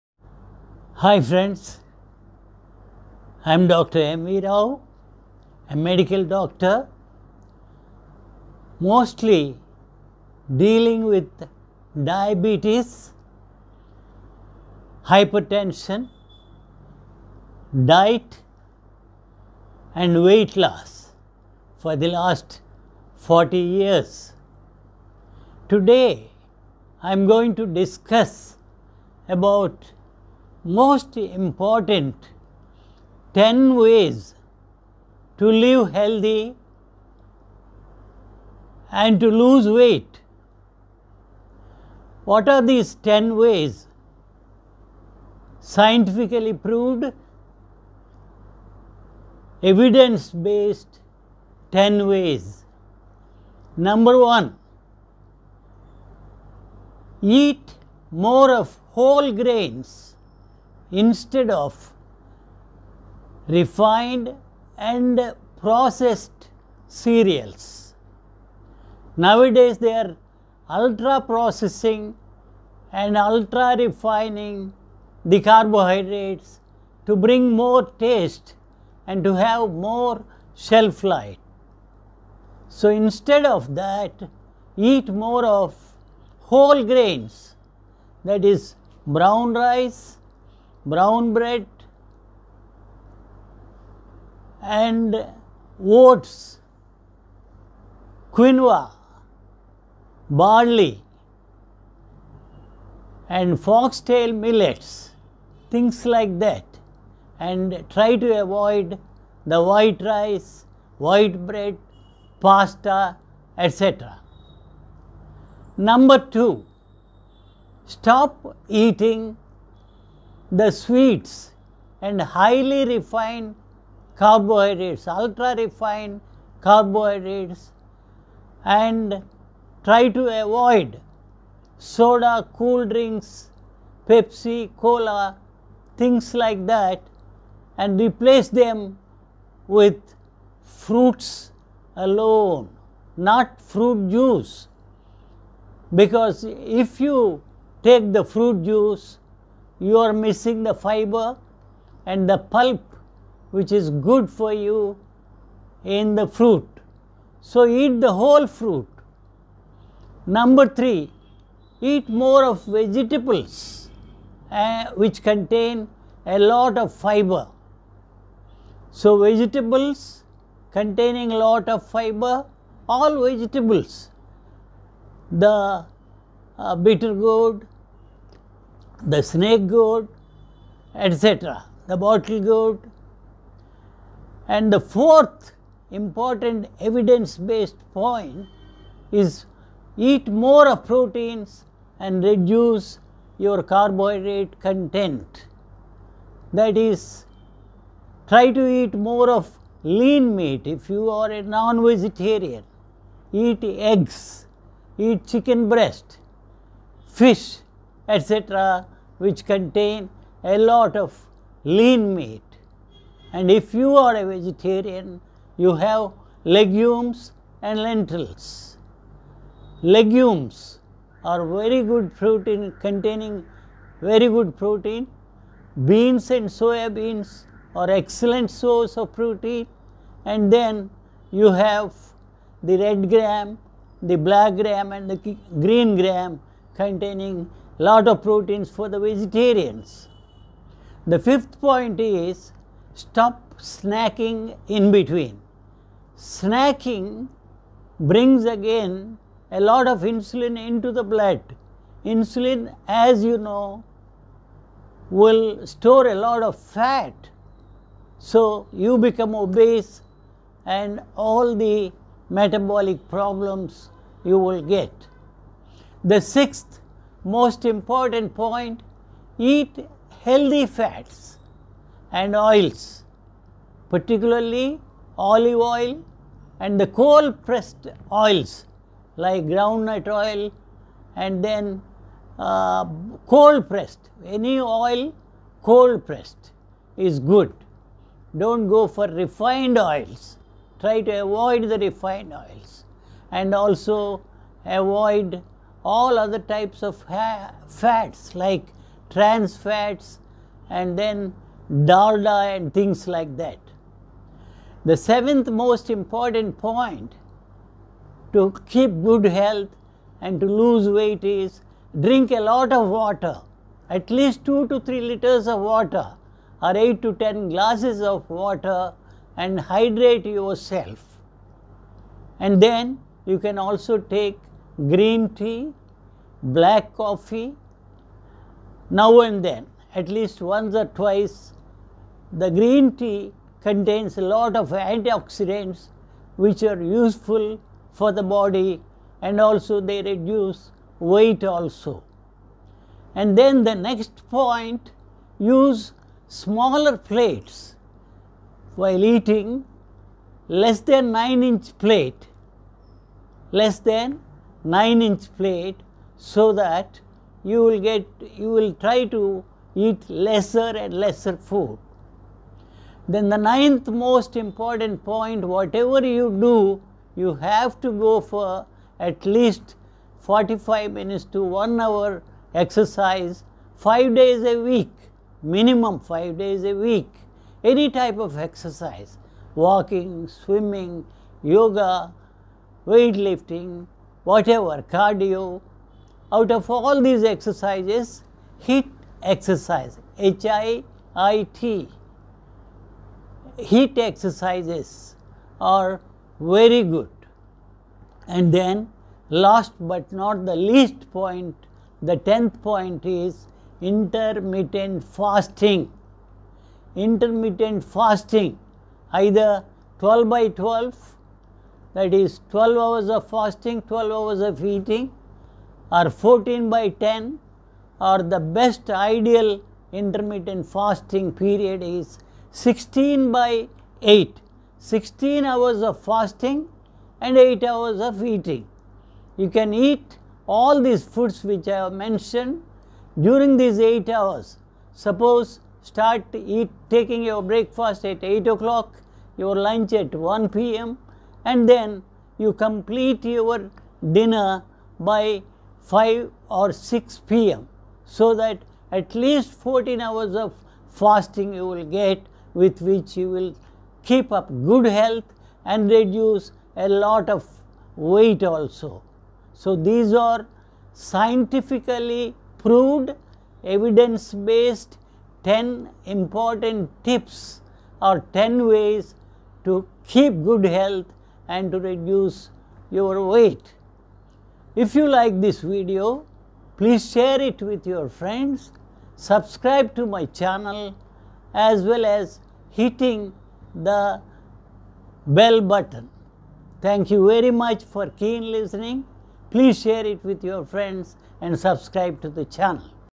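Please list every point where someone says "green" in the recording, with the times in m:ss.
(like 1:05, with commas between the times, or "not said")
3:55, 5:24, 5:32.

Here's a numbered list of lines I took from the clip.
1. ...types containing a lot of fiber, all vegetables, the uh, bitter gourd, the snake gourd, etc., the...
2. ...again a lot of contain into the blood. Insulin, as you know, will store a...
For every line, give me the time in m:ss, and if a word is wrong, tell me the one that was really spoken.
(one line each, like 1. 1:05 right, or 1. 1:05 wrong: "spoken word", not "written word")
1. 2:49 wrong: "vegetables", not "types"
2. 4:08 wrong: "insulin", not "contain".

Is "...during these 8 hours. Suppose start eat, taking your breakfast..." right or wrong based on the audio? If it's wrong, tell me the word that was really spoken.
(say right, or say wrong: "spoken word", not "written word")
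right.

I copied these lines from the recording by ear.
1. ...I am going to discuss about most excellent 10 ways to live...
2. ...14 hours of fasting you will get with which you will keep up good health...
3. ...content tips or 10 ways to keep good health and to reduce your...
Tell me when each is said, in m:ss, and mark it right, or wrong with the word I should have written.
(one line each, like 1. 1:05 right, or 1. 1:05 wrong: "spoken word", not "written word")
1. 0:27 wrong: "important", not "excellent"
2. 7:29 right
3. 7:46 wrong: "important", not "content".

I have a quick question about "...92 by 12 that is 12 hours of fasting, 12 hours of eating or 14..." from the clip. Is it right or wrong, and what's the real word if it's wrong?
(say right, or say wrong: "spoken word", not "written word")
wrong: "12", not "92".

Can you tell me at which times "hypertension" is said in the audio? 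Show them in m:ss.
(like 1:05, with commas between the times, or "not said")
0:15.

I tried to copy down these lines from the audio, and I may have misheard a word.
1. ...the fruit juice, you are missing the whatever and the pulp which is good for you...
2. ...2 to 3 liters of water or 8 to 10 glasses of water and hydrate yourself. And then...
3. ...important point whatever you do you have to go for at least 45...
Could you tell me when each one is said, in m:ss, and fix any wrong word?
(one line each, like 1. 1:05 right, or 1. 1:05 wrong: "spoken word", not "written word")
1. 2:28 wrong: "fiber", not "whatever"
2. 5:14 right
3. 6:04 right.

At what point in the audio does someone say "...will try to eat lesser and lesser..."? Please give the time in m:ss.
5:58.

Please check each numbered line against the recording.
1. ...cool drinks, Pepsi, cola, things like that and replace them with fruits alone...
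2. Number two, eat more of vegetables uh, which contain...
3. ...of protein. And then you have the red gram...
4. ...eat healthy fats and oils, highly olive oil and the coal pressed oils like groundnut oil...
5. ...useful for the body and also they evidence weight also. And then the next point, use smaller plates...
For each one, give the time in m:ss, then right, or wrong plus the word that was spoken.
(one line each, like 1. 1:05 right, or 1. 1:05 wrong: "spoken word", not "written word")
1. 2:12 right
2. 2:40 wrong: "three", not "two"
3. 3:48 right
4. 4:29 wrong: "particularly", not "highly"
5. 5:36 wrong: "reduce", not "evidence".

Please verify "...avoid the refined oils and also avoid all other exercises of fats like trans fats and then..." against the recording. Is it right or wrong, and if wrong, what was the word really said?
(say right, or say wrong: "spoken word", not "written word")
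wrong: "types", not "exercises".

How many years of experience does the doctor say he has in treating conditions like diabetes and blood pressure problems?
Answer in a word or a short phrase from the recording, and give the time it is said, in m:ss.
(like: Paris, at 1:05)
40 years, at 0:23.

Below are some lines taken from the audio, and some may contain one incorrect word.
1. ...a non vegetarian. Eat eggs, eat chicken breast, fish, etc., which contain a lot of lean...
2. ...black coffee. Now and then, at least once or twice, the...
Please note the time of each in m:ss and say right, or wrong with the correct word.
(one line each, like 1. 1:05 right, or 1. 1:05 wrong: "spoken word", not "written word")
1. 3:21 right
2. 5:26 right.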